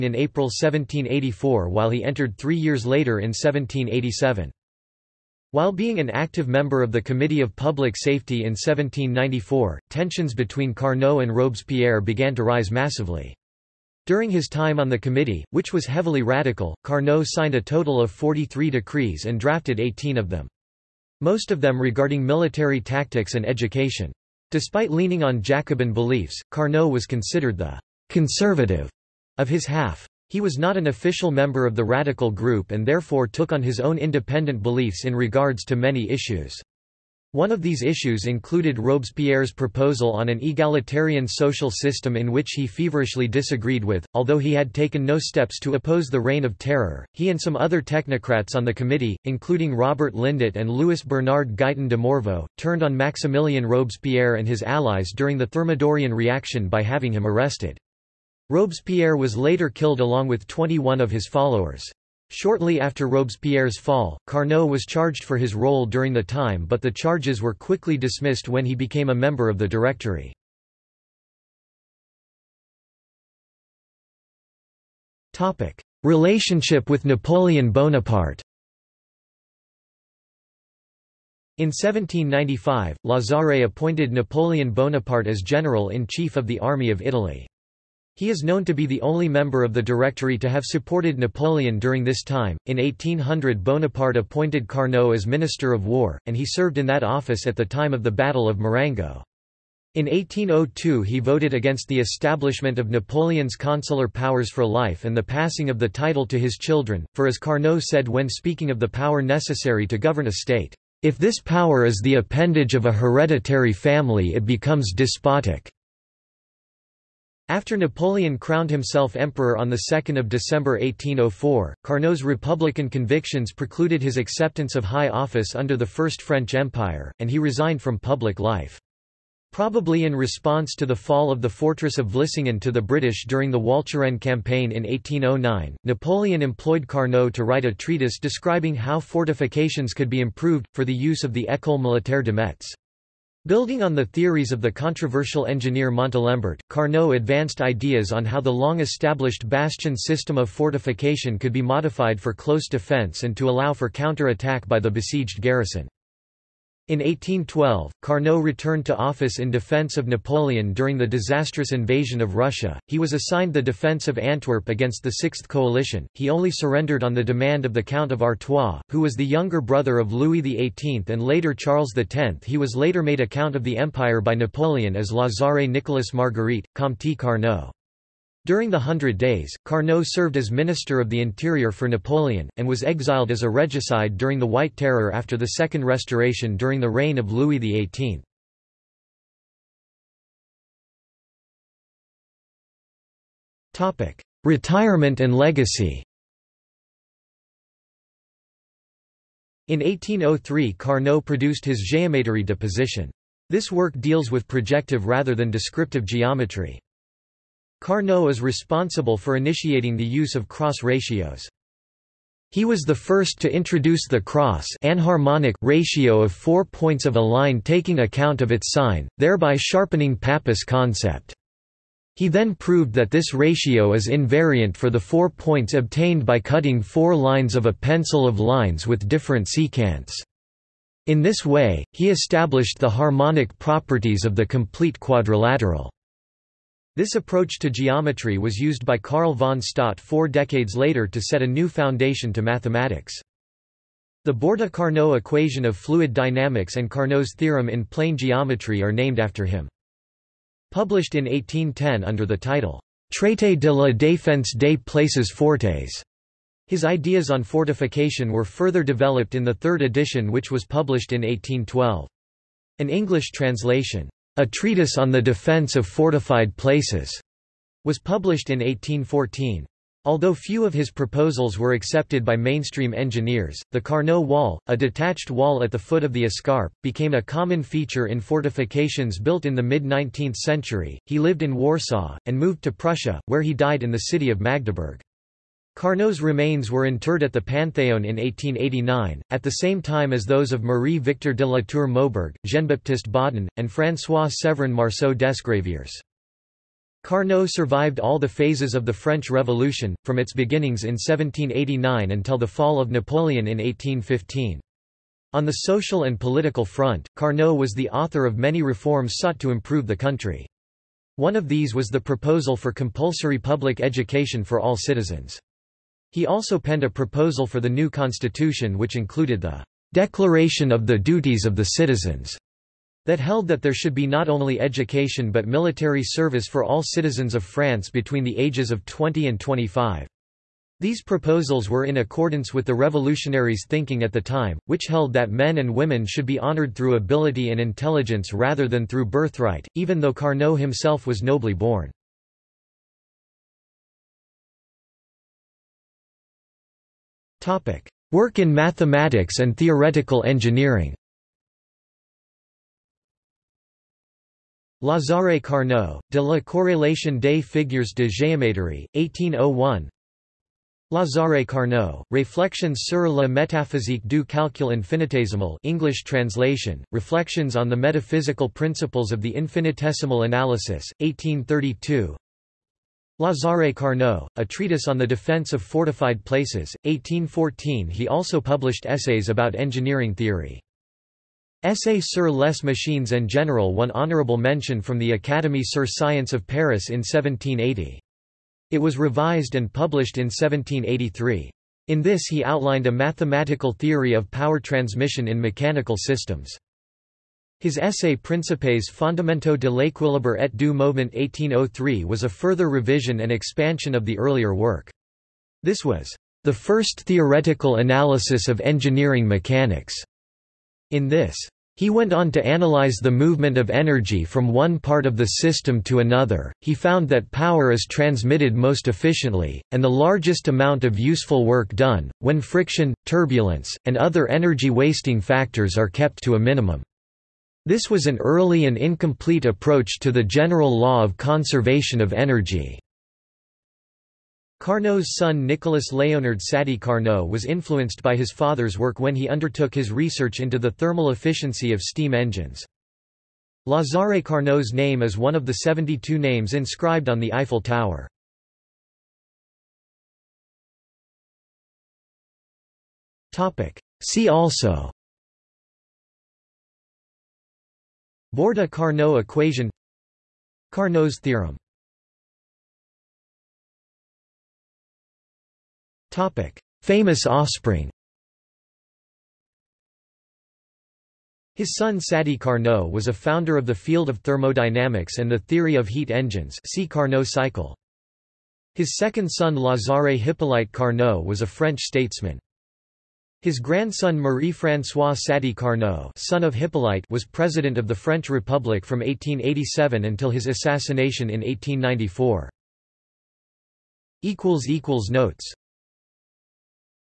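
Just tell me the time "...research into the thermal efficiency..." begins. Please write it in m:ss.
7:19.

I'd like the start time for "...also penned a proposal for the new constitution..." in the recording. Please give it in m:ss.
5:16.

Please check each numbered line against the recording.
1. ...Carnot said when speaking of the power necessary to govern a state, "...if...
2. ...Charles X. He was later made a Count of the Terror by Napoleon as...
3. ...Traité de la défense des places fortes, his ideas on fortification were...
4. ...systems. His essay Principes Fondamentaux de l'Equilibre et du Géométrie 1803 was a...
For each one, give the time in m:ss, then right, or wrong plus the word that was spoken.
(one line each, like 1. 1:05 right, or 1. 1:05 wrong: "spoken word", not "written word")
1. 1:47 right
2. 2:51 wrong: "Empire", not "Terror"
3. 4:13 right
4. 6:35 wrong: "Mouvement", not "Géométrie".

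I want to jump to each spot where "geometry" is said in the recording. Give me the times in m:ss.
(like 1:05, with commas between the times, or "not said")
3:26, 3:57, 4:08.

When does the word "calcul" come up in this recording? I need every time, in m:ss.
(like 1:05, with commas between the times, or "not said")
6:04.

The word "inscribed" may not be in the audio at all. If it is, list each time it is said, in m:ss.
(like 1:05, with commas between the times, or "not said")
7:26.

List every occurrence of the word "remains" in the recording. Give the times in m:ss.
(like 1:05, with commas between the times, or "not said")
4:46.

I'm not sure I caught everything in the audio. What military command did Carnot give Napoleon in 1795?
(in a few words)
General-in-Chief of the Army of Italy.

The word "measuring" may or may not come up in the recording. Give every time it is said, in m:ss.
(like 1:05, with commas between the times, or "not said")
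not said.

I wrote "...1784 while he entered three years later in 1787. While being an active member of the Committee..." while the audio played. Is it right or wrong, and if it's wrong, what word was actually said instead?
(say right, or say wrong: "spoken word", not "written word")
right.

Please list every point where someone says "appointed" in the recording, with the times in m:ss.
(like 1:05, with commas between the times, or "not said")
1:23, 1:34.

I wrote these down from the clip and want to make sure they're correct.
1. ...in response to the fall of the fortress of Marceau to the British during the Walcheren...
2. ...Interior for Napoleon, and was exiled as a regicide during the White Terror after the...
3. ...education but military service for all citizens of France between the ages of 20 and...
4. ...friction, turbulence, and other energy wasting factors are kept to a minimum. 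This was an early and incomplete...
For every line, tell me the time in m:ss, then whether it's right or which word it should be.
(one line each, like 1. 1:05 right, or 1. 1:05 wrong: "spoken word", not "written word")
1. 2:10 wrong: "Vlissingen", not "Marceau"
2. 3:01 right
3. 5:24 right
4. 7:02 right.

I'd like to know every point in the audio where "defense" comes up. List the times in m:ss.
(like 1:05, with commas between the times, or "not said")
2:32, 2:39, 2:43, 4:25, 6:15.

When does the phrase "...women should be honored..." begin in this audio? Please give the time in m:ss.
5:35.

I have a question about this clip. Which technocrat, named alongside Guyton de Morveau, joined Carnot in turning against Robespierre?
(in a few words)
Robert Lindet.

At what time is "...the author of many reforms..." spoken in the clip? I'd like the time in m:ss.
5:07.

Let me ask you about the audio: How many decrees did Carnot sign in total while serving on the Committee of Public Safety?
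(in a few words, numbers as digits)
43.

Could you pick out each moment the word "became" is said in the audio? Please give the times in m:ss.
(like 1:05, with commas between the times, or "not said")
1:08, 4:36.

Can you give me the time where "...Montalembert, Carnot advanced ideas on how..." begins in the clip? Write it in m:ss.
2:25.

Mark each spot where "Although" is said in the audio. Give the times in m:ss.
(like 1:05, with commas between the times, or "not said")
0:44, 4:30.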